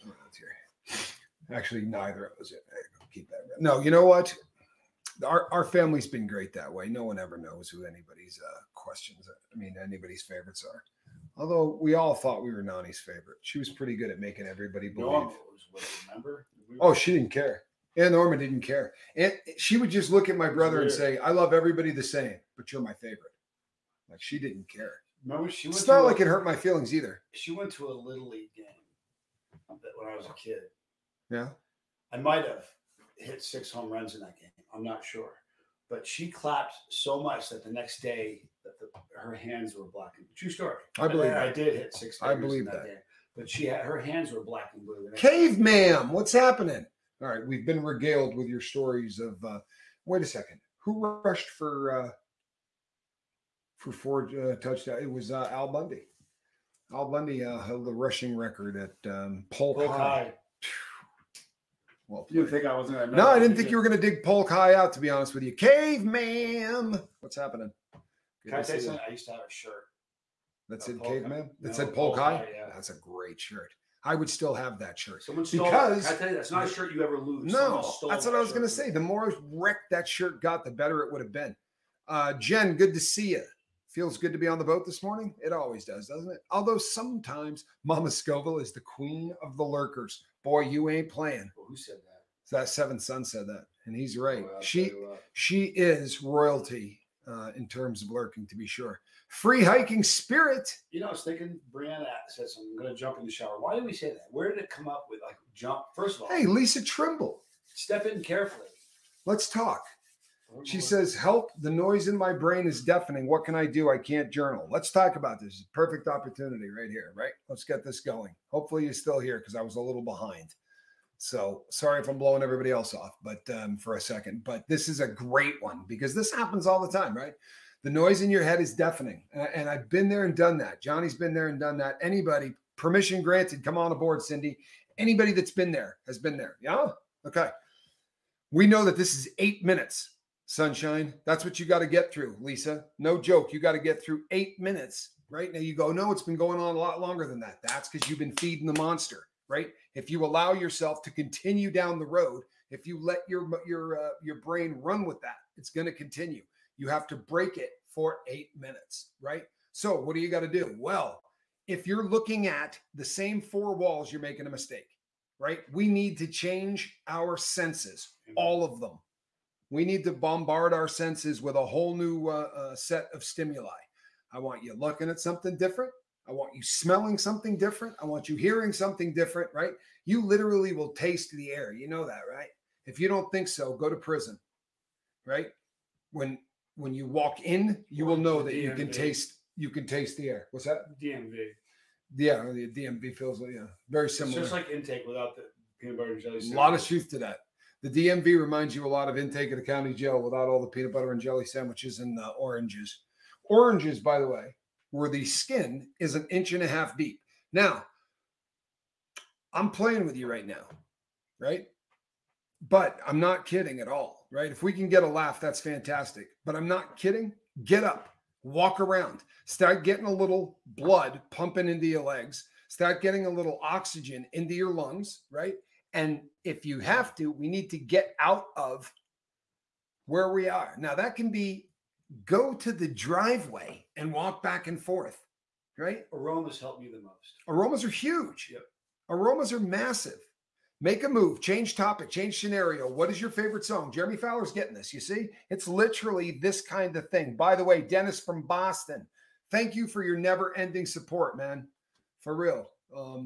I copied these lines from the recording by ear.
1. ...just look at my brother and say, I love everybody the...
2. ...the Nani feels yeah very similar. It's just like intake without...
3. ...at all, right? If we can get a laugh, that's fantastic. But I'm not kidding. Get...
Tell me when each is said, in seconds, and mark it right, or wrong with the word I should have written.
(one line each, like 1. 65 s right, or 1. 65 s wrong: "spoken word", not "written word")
1. 19 s right
2. 192 s wrong: "DMV", not "Nani"
3. 213 s right.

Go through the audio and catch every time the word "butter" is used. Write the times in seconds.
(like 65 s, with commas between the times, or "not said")
195 s, 200 s.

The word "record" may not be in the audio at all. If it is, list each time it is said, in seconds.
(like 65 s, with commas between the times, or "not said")
58 s.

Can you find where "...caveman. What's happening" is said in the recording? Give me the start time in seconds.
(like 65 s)
65 s.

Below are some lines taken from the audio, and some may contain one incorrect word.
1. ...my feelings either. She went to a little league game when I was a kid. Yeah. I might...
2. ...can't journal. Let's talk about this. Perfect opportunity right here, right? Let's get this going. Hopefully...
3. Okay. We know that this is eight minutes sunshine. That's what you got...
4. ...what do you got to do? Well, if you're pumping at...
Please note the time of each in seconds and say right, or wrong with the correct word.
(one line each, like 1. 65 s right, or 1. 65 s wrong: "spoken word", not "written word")
1. 26 s right
2. 113 s right
3. 137 s right
4. 159 s wrong: "looking", not "pumping".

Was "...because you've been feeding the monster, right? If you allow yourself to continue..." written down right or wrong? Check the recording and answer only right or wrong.
right.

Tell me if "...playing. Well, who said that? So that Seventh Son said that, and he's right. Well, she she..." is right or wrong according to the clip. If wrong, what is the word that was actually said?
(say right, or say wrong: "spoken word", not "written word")
right.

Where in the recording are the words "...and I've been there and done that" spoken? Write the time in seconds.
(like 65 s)
129 s.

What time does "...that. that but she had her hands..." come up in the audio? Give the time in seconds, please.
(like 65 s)
42 s.